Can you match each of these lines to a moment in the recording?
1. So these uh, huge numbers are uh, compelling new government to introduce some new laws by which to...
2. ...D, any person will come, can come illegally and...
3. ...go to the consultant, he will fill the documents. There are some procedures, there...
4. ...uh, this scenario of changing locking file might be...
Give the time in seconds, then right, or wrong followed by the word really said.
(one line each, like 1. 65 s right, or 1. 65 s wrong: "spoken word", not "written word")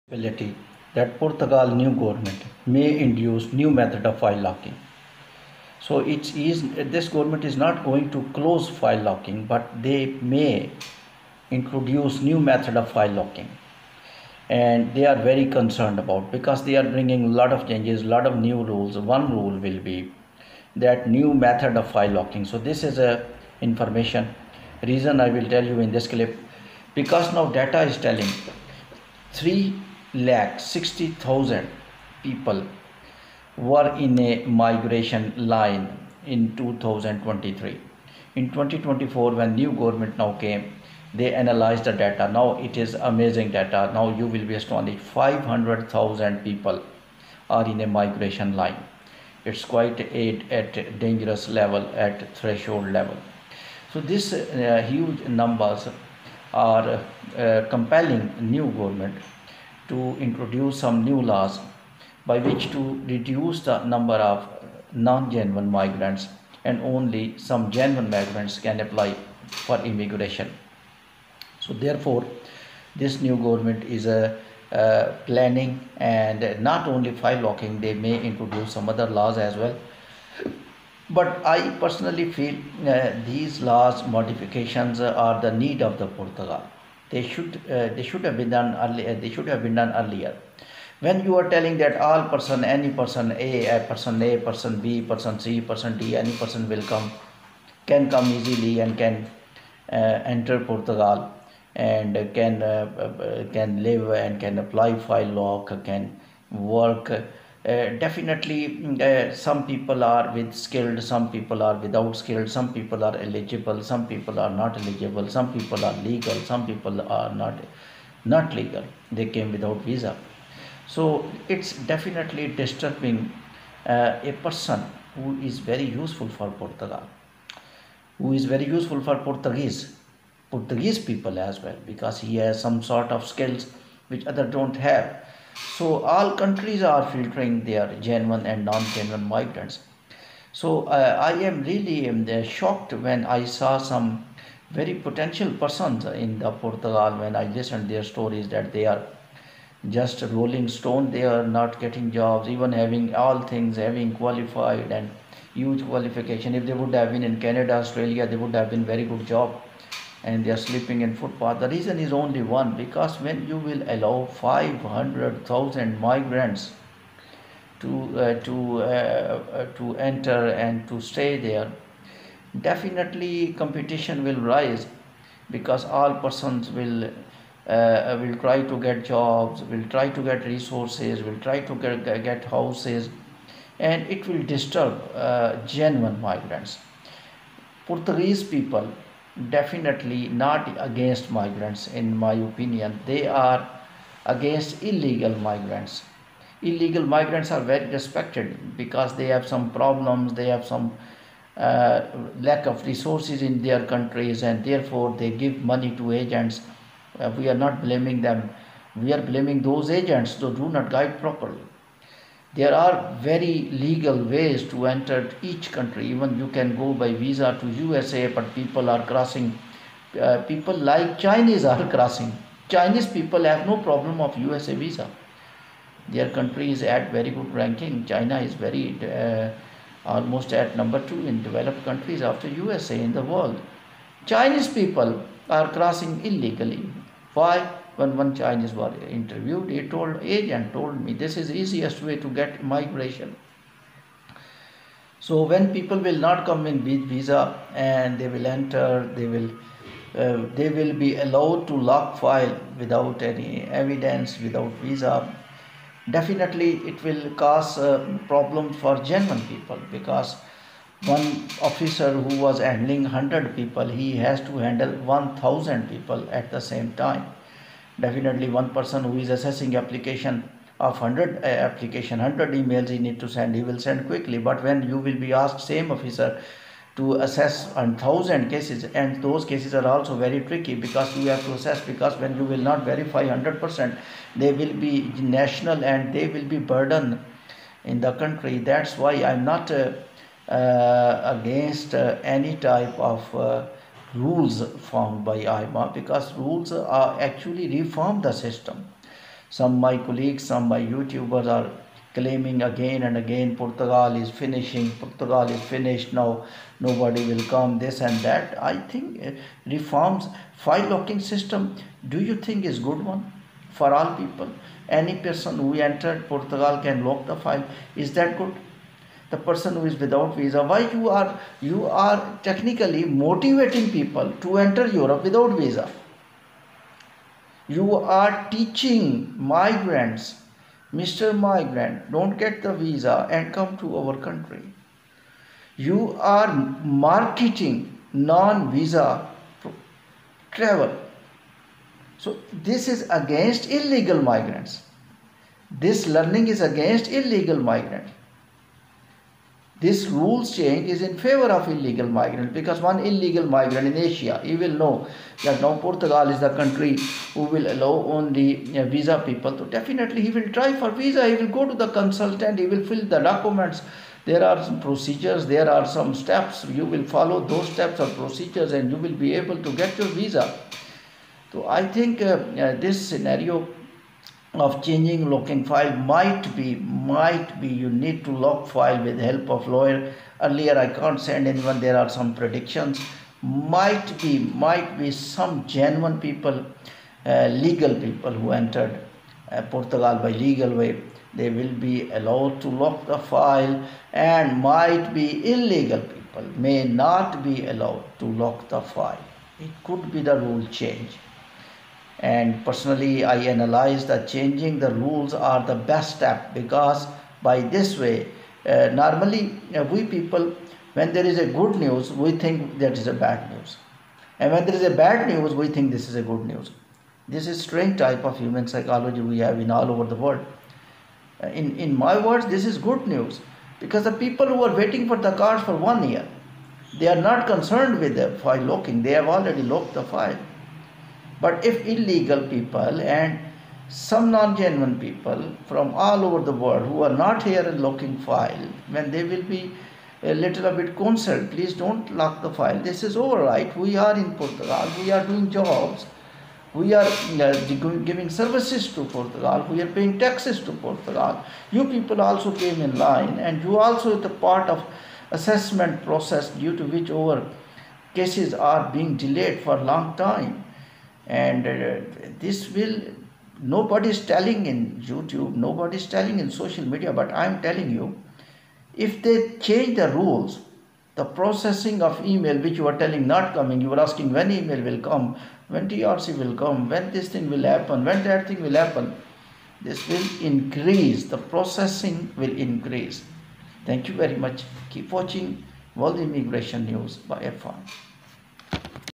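1. 53 s right
2. 95 s wrong: "easily", not "illegally"
3. 361 s right
4. 372 s right.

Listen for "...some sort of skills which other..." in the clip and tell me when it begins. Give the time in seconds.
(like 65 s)
132 s.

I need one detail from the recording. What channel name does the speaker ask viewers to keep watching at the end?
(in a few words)
World Immigration News.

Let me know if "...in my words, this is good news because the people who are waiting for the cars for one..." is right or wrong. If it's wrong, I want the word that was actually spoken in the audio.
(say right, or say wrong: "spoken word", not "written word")
right.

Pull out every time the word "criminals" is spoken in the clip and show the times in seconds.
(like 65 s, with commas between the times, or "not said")
not said.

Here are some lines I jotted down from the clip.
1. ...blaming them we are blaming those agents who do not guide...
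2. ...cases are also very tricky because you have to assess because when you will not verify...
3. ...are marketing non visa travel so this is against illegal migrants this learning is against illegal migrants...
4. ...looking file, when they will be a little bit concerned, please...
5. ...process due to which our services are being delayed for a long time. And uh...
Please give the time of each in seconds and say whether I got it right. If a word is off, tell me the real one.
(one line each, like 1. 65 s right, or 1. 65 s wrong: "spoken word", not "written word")
1. 207 s right
2. 279 s right
3. 336 s right
4. 437 s right
5. 456 s wrong: "cases", not "services".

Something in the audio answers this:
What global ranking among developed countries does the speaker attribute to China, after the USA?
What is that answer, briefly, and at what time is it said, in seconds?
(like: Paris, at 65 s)
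number 2, at 230 s.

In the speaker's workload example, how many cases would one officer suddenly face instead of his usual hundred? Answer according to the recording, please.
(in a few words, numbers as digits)
1000.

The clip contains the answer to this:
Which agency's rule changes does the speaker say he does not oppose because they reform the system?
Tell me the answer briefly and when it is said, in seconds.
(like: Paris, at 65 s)
AIMA, at 295 s.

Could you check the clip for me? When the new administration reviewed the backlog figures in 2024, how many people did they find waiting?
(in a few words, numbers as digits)
500,000.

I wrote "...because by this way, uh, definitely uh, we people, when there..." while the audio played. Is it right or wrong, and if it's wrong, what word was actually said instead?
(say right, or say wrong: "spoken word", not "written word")
wrong: "normally", not "definitely".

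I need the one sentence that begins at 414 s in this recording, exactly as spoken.
And when there is a bad news, we think this is a good news.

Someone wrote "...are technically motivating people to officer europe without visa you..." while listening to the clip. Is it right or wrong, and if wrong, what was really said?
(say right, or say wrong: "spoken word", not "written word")
wrong: "enter", not "officer".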